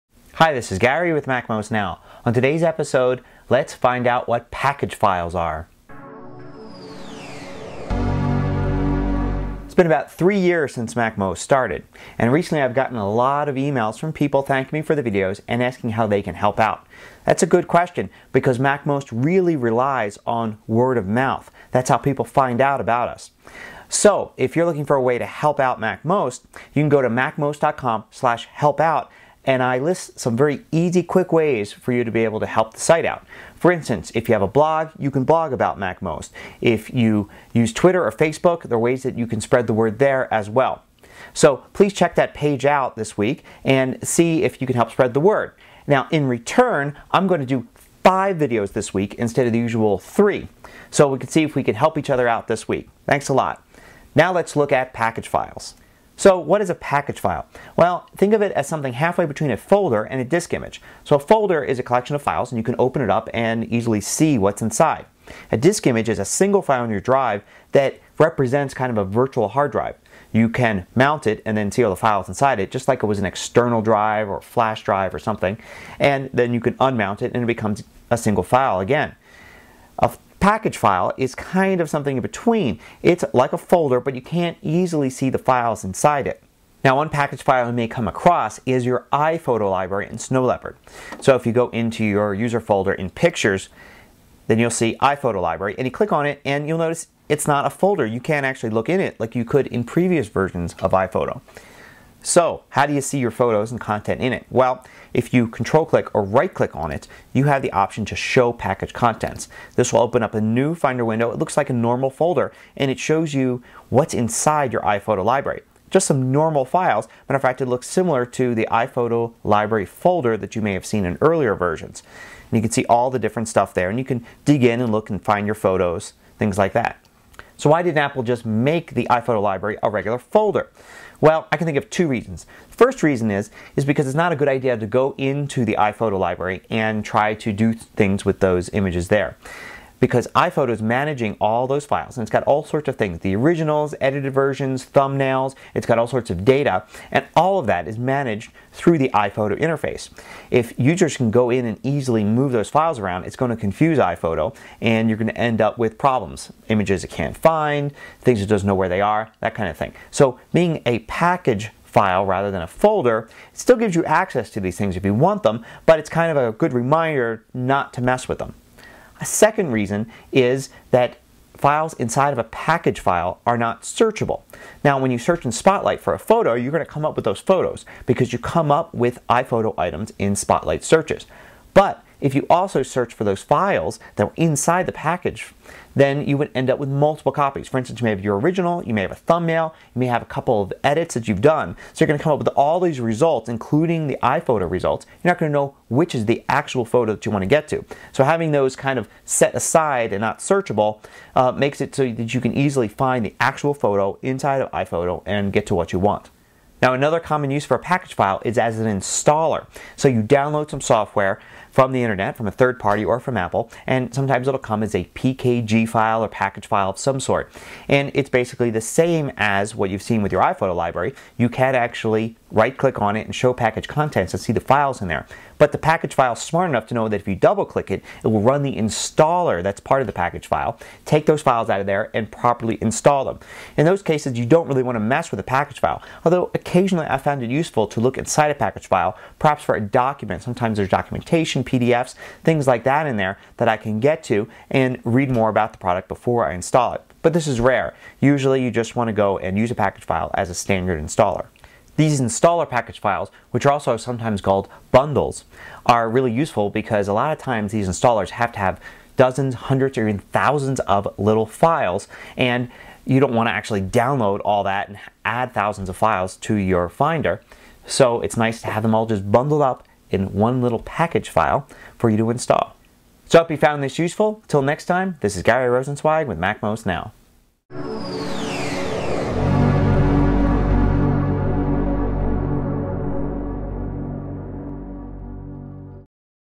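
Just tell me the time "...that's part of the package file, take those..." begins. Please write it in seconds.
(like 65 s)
229 s.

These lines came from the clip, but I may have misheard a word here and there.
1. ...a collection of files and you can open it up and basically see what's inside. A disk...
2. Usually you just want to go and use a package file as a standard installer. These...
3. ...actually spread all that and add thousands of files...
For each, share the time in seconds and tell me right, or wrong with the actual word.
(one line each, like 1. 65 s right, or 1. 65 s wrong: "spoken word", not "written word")
1. 61 s wrong: "easily", not "basically"
2. 248 s right
3. 263 s wrong: "download", not "spread".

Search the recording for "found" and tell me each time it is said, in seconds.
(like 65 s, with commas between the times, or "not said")
237 s, 273 s.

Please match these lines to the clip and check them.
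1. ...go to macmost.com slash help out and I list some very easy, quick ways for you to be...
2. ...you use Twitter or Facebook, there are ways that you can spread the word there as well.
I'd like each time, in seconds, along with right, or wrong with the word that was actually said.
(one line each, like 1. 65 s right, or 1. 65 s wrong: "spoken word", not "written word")
1. 26 s right
2. 36 s right.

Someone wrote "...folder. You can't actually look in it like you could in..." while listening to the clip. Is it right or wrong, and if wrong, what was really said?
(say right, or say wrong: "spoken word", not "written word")
right.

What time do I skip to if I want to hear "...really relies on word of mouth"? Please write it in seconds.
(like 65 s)
19 s.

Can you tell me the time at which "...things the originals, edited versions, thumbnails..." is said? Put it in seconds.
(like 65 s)
142 s.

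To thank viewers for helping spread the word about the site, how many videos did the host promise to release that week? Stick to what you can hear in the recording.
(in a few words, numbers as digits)
5.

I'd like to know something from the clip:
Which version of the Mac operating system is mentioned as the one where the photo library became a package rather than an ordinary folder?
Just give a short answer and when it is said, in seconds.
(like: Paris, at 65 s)
Snow Leopard, at 90 s.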